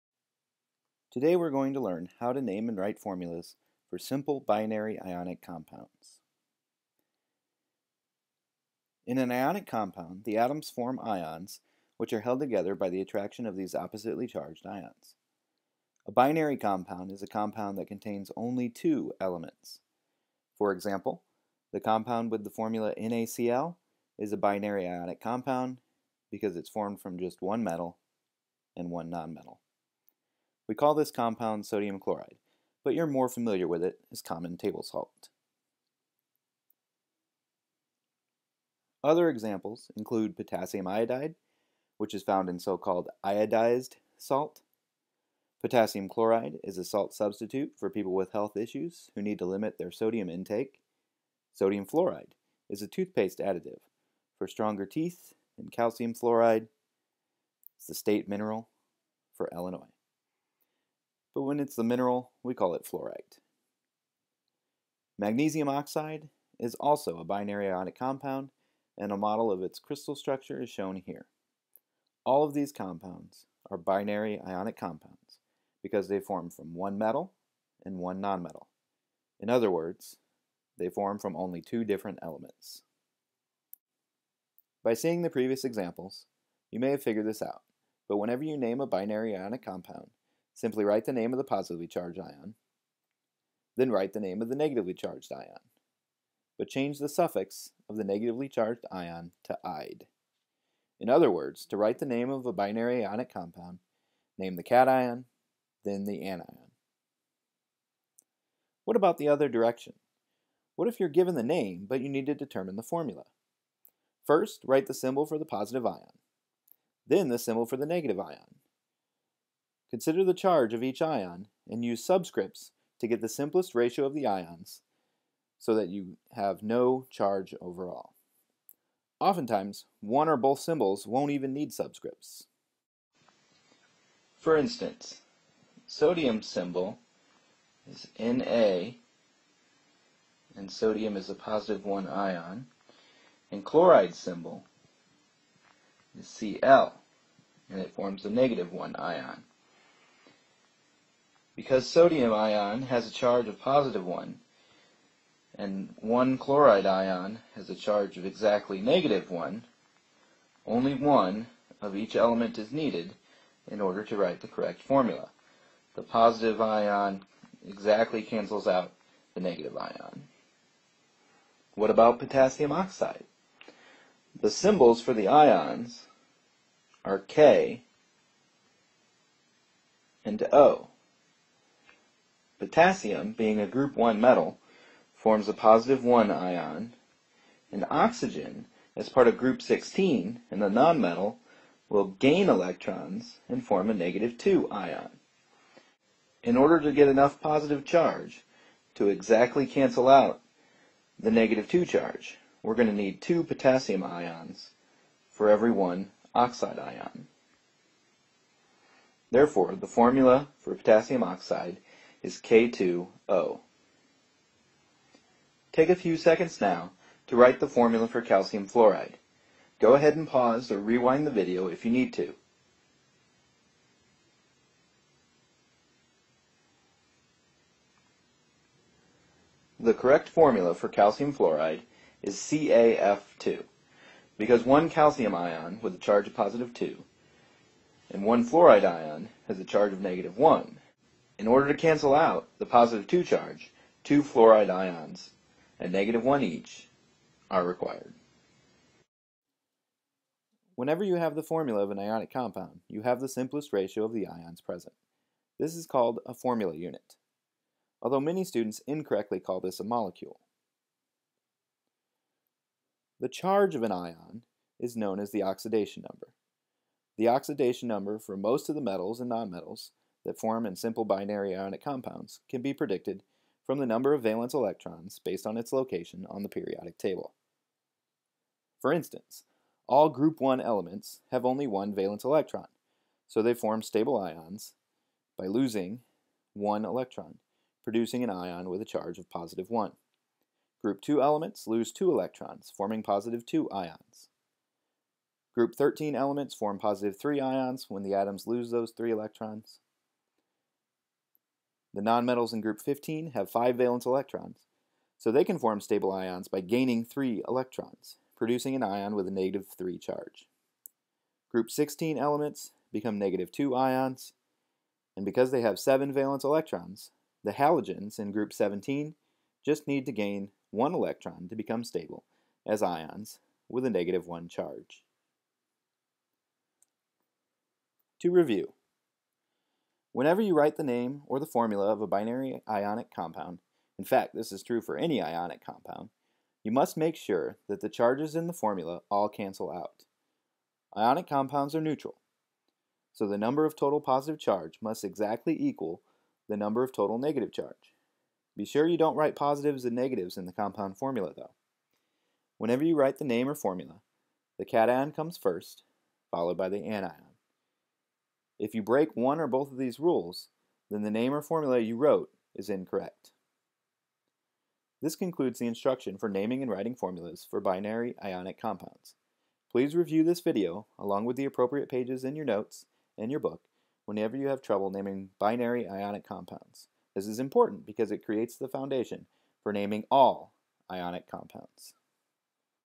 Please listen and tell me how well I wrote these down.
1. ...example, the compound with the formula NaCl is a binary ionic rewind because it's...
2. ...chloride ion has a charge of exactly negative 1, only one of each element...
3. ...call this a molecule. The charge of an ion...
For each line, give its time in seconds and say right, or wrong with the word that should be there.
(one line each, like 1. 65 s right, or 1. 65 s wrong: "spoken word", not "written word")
1. 20 s wrong: "compound", not "rewind"
2. 156 s right
3. 259 s right.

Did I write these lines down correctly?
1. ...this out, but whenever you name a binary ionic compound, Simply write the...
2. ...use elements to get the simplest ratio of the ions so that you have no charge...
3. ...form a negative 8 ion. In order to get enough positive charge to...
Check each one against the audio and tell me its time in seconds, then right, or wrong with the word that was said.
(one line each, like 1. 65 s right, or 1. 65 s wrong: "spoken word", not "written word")
1. 87 s right
2. 121 s wrong: "subscripts", not "elements"
3. 193 s wrong: "2", not "8".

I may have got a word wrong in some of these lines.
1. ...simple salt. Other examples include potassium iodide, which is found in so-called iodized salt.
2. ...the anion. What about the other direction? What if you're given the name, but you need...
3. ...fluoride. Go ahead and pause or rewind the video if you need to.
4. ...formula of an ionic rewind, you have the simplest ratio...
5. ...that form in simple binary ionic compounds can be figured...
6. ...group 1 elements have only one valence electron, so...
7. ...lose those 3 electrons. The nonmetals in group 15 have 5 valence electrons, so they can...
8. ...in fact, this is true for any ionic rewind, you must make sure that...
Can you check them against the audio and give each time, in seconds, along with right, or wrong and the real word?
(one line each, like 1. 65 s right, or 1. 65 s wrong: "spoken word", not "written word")
1. 34 s wrong: "table", not "simple"
2. 106 s right
3. 218 s right
4. 251 s wrong: "compound", not "rewind"
5. 270 s wrong: "predicted", not "figured"
6. 280 s right
7. 298 s right
8. 333 s wrong: "compound", not "rewind".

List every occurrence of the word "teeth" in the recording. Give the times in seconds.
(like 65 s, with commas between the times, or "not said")
54 s.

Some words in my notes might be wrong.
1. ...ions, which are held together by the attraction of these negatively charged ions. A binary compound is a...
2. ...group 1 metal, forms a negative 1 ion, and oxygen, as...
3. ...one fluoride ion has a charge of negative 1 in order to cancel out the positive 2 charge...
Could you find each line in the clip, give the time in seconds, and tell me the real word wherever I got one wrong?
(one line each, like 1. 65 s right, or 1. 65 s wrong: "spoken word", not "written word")
1. 11 s wrong: "oppositely", not "negatively"
2. 183 s wrong: "positive", not "negative"
3. 238 s right.